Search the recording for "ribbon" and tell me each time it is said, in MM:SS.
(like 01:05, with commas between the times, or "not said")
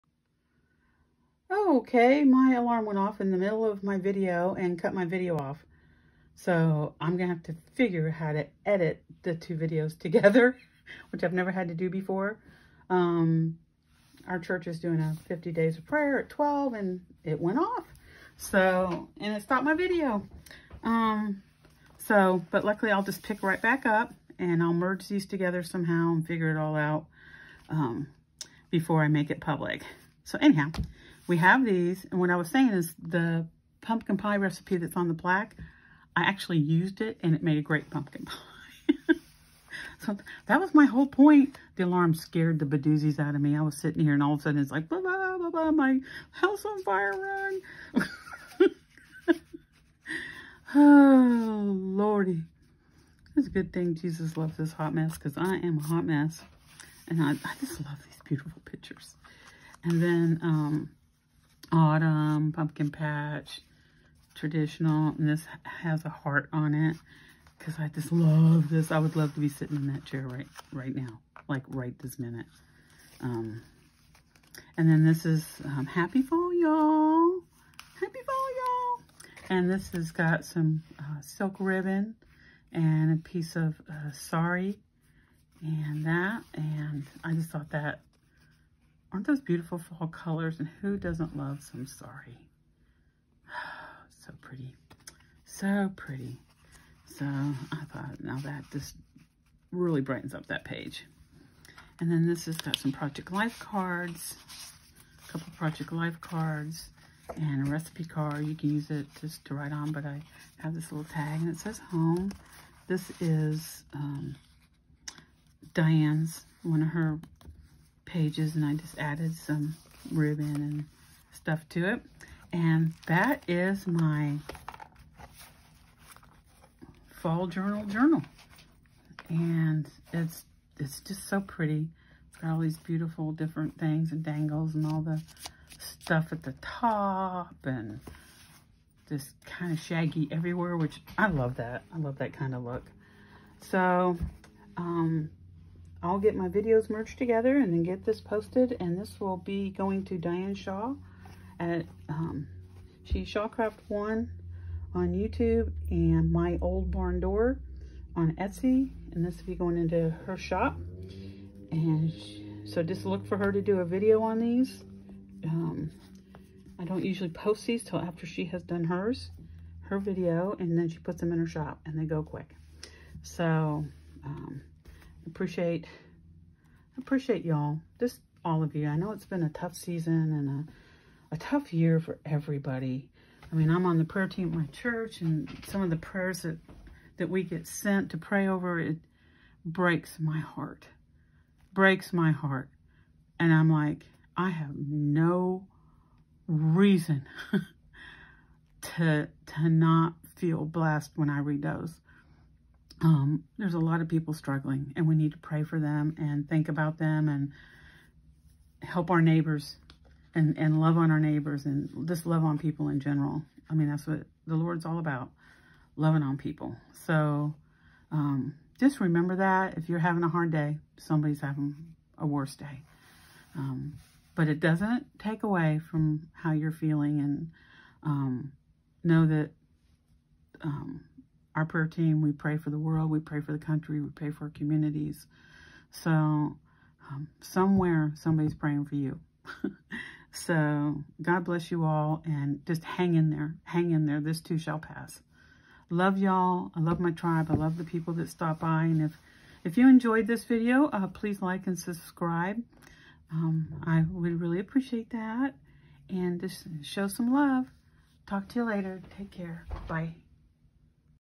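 01:21, 02:00.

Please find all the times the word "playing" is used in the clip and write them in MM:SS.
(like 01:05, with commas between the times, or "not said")
not said.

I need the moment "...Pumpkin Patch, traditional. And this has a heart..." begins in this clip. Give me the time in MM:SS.
01:02.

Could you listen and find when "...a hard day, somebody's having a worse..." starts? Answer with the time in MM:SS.
03:40.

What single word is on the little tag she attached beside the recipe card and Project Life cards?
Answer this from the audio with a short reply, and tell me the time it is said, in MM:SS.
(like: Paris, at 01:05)
Home, at 01:51.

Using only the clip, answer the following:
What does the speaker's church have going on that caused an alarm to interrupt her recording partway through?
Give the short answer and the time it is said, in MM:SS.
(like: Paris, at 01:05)
50 days of prayer, at 00:15.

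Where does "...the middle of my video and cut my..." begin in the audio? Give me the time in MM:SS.
00:03.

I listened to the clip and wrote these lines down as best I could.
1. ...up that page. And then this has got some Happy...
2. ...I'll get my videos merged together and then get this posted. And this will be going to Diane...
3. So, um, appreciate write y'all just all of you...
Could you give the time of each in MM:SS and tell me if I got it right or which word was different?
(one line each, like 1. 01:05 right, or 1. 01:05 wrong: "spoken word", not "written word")
1. 01:40 wrong: "Project", not "Happy"
2. 02:26 right
3. 02:53 wrong: "appreciate", not "write".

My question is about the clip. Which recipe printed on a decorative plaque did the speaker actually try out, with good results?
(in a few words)
Pumpkin pie.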